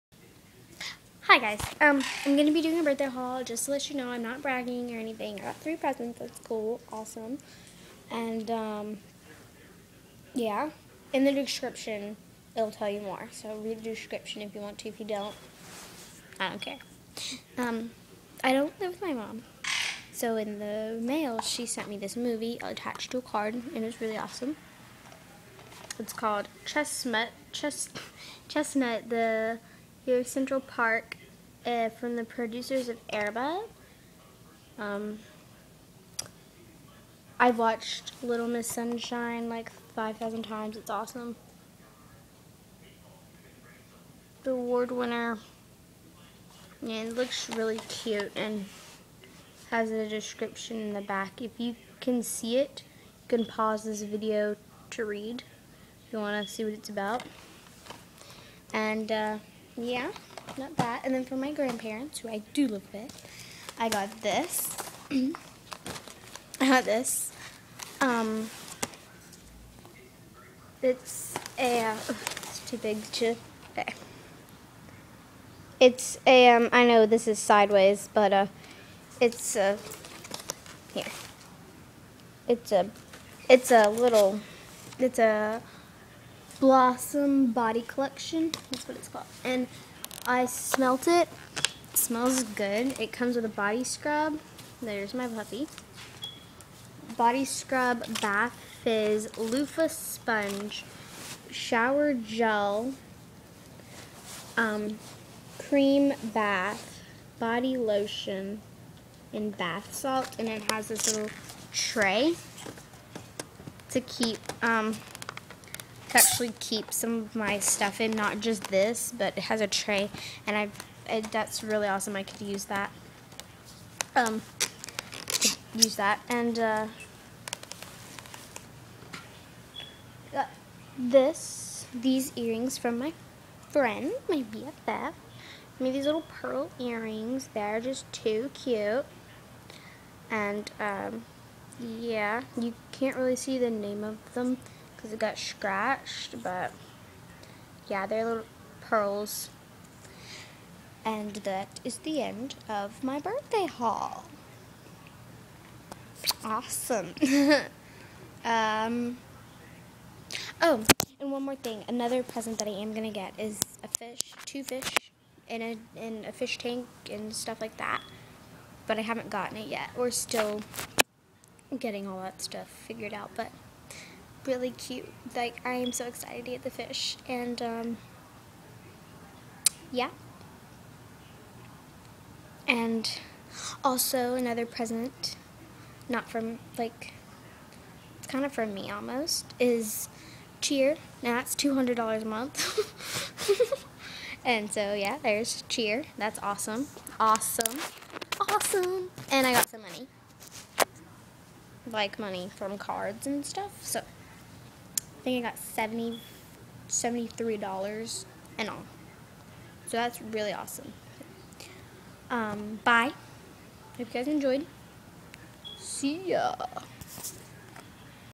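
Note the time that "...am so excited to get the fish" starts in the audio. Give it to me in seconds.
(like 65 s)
175 s.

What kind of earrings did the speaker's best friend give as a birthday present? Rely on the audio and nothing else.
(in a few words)
Pearl earrings.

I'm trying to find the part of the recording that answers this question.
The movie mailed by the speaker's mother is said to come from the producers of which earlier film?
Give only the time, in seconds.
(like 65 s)
33 s.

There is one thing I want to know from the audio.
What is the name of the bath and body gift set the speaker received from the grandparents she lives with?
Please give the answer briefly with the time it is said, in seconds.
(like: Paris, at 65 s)
Blossom Body Collection, at 86 s.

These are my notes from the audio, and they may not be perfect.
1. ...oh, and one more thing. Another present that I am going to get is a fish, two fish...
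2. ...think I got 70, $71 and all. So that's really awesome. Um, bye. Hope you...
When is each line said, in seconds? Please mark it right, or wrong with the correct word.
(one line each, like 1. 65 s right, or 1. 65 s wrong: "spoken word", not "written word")
1. 160 s right
2. 205 s wrong: "73", not "71".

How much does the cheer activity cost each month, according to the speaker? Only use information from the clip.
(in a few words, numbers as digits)
$200.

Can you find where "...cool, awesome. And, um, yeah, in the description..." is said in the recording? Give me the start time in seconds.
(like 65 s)
6 s.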